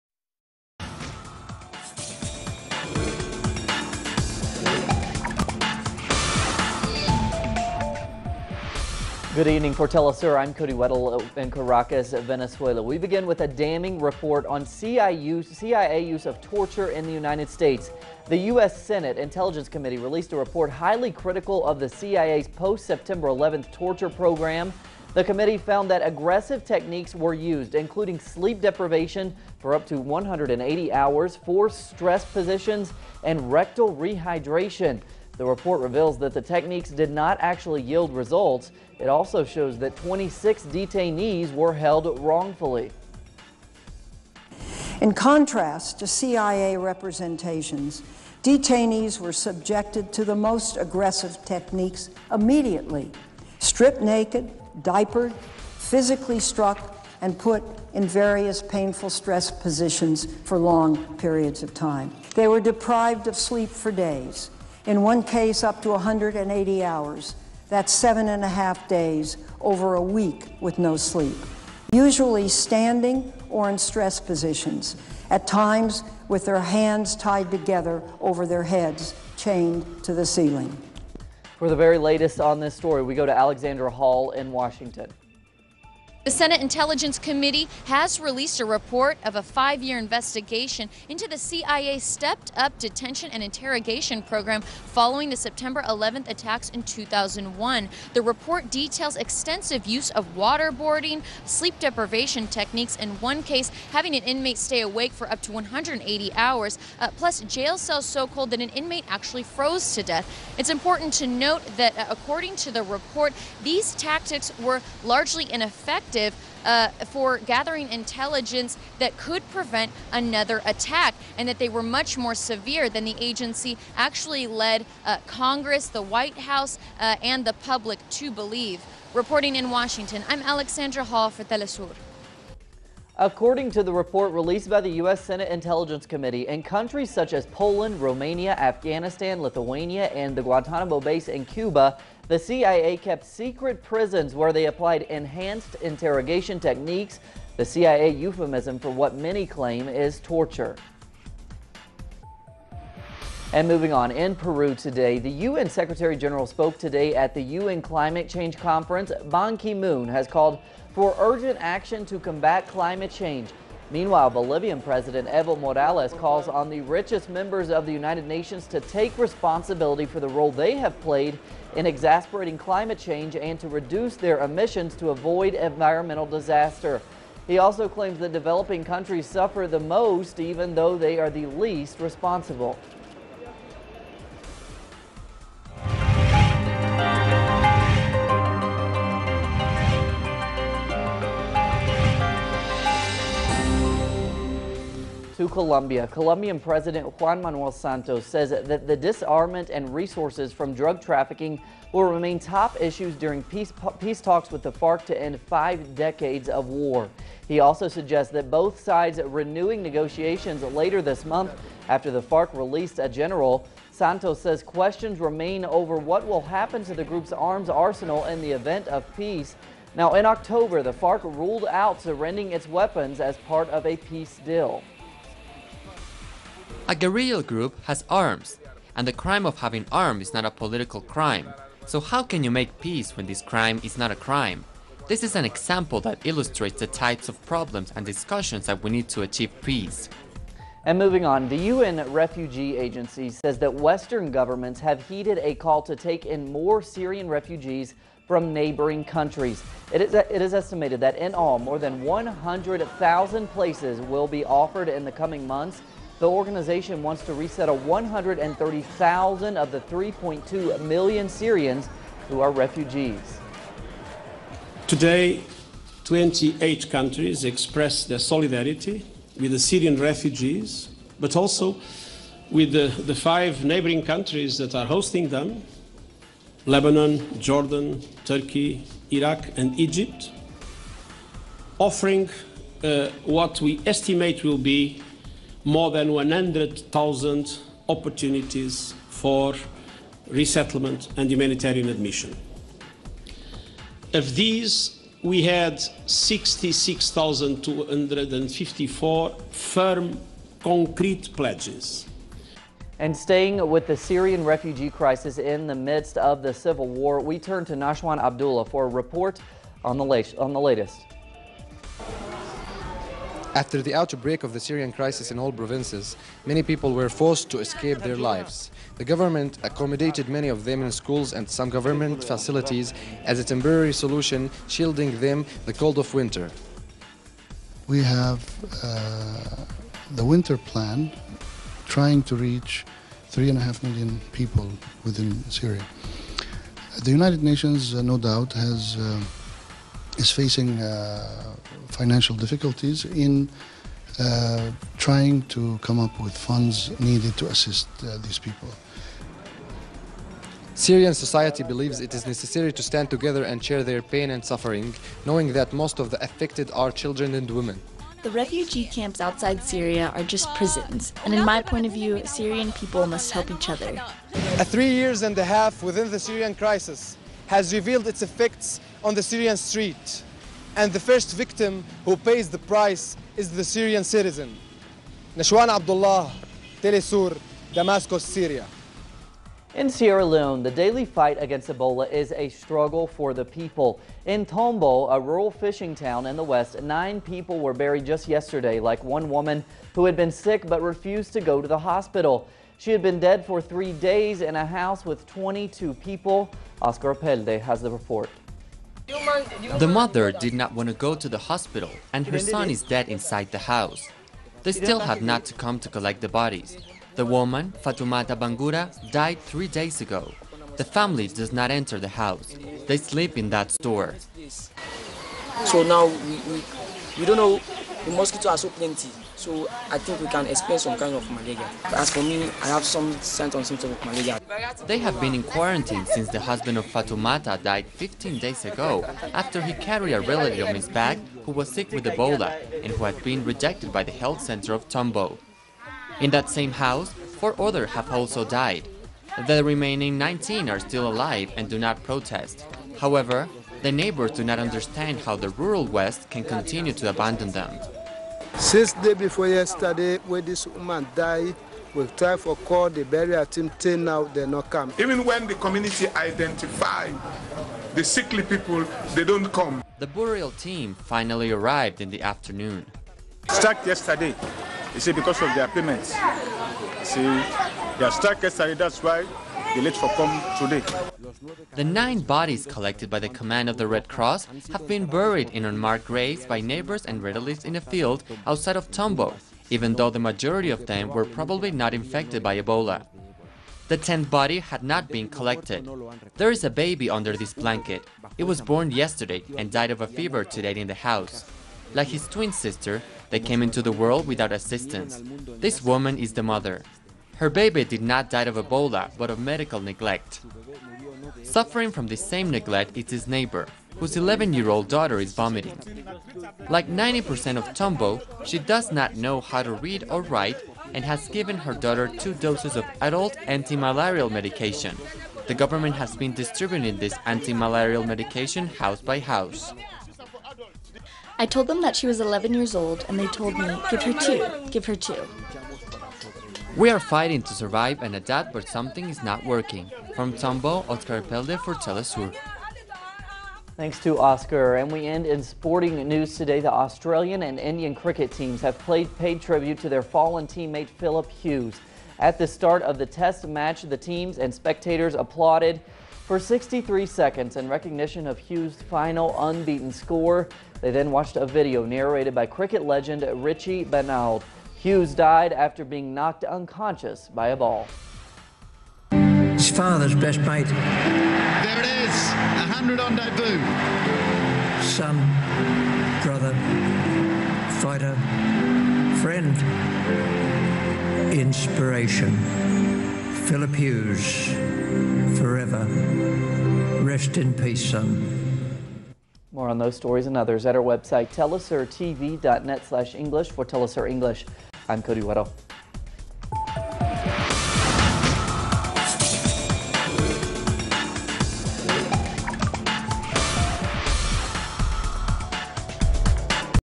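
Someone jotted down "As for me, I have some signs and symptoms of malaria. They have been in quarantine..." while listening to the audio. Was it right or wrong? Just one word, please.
right.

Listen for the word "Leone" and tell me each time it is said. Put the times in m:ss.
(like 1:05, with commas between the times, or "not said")
6:20.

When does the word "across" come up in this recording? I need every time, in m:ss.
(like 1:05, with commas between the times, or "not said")
not said.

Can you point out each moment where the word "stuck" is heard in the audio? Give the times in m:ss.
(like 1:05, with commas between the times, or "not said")
7:43, 7:48.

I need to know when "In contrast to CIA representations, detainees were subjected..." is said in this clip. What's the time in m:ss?
0:45.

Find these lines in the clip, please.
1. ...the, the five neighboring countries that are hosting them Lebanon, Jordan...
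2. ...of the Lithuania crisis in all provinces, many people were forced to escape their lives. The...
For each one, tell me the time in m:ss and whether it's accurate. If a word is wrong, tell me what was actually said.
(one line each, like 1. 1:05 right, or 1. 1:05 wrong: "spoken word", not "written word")
1. 4:32 right
2. 5:14 wrong: "Syrian", not "Lithuania".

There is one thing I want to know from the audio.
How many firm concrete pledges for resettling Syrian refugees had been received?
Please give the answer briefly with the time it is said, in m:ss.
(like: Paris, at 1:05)
66,254, at 4:56.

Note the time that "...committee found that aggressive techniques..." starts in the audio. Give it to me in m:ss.
0:25.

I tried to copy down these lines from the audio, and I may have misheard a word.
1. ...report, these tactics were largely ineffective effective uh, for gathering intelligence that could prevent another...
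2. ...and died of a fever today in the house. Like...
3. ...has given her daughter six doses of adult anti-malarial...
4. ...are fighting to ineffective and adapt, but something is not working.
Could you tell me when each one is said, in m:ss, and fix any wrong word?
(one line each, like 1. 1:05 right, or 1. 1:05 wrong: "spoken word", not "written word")
1. 1:52 right
2. 8:09 right
3. 8:31 wrong: "two", not "six"
4. 8:46 wrong: "survive", not "ineffective".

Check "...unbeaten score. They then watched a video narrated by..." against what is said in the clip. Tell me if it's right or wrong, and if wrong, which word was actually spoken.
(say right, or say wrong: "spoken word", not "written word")
right.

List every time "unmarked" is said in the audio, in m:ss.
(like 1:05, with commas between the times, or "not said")
7:55.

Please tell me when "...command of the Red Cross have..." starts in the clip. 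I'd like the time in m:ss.
7:53.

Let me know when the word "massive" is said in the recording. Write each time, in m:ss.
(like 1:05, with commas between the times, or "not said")
not said.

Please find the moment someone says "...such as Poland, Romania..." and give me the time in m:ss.
2:17.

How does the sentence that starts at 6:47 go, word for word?
The woman, Fatumata Bangura, died three days ago.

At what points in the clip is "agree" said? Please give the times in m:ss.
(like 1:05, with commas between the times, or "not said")
not said.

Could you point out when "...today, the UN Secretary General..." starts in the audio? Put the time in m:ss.
2:34.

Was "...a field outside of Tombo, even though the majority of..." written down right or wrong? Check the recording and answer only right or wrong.
right.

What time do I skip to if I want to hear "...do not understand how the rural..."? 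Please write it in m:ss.
7:24.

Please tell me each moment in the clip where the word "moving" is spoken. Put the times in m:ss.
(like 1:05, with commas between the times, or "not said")
2:33, 4:00.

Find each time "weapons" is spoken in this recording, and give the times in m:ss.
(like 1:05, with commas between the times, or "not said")
3:42.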